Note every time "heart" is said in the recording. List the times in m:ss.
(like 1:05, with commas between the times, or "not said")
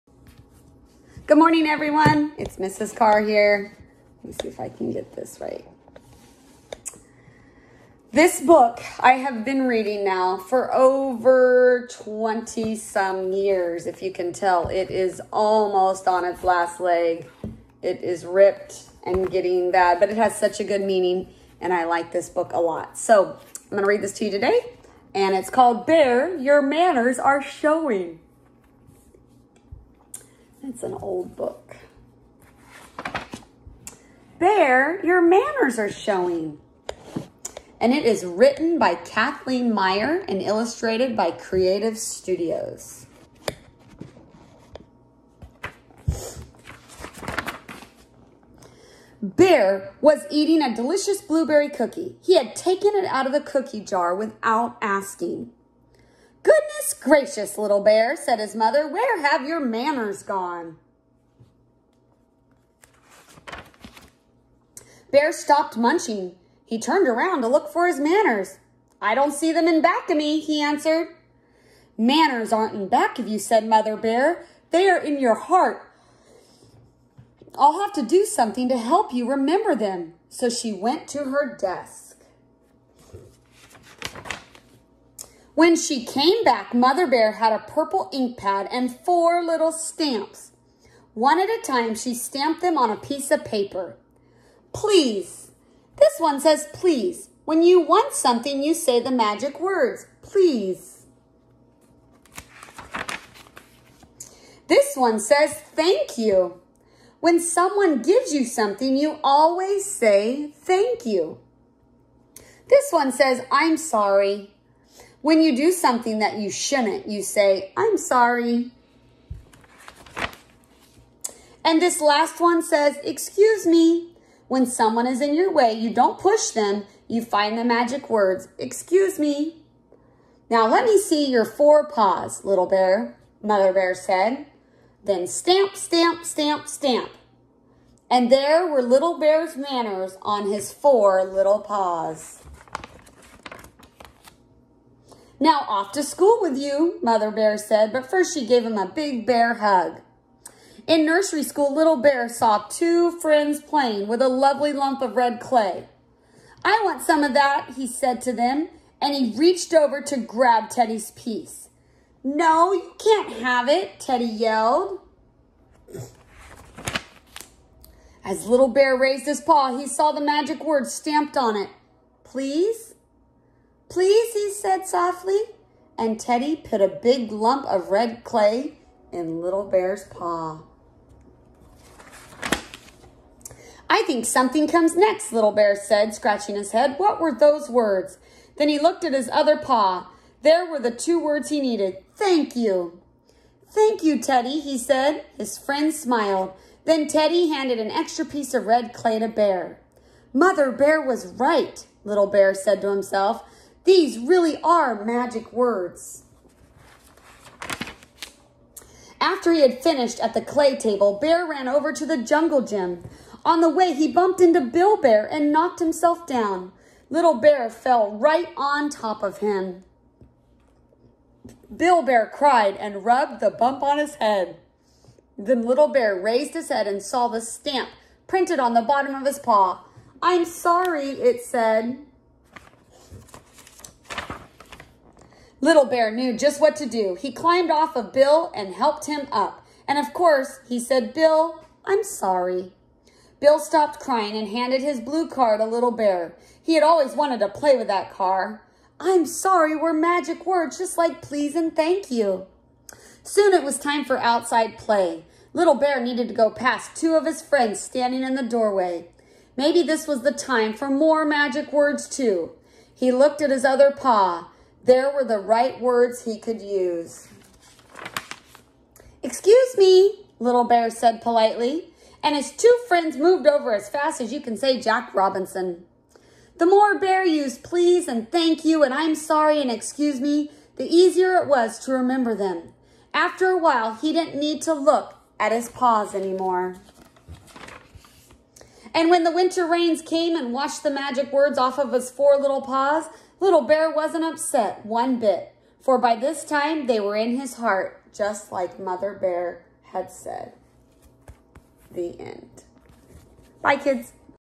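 1:15, 4:57.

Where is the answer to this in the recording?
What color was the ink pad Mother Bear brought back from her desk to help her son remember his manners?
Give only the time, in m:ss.
1:27.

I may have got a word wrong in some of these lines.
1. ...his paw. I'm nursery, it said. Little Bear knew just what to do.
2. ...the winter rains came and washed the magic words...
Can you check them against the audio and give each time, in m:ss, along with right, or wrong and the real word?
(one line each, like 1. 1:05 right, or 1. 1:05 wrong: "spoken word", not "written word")
1. 3:49 wrong: "sorry", not "nursery"
2. 4:49 right.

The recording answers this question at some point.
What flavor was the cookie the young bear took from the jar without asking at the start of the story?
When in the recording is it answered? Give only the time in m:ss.
0:51.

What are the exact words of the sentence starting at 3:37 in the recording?
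Little Bear fell right on top of him.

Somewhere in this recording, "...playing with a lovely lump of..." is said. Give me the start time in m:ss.
2:33.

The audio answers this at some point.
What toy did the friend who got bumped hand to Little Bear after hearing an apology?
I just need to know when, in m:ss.
4:04.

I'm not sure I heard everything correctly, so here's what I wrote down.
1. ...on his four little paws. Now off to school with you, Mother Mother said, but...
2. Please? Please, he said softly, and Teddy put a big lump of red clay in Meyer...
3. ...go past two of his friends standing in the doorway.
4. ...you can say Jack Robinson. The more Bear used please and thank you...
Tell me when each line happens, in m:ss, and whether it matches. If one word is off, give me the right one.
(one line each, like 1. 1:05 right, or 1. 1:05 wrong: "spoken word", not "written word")
1. 2:20 wrong: "Bear", not "Mother"
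2. 2:52 wrong: "Little", not "Meyer"
3. 4:16 right
4. 4:34 right.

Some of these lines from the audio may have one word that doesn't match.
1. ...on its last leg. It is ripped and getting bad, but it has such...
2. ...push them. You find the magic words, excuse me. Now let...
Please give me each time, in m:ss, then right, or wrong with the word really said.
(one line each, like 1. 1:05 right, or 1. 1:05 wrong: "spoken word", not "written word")
1. 0:16 right
2. 2:06 right.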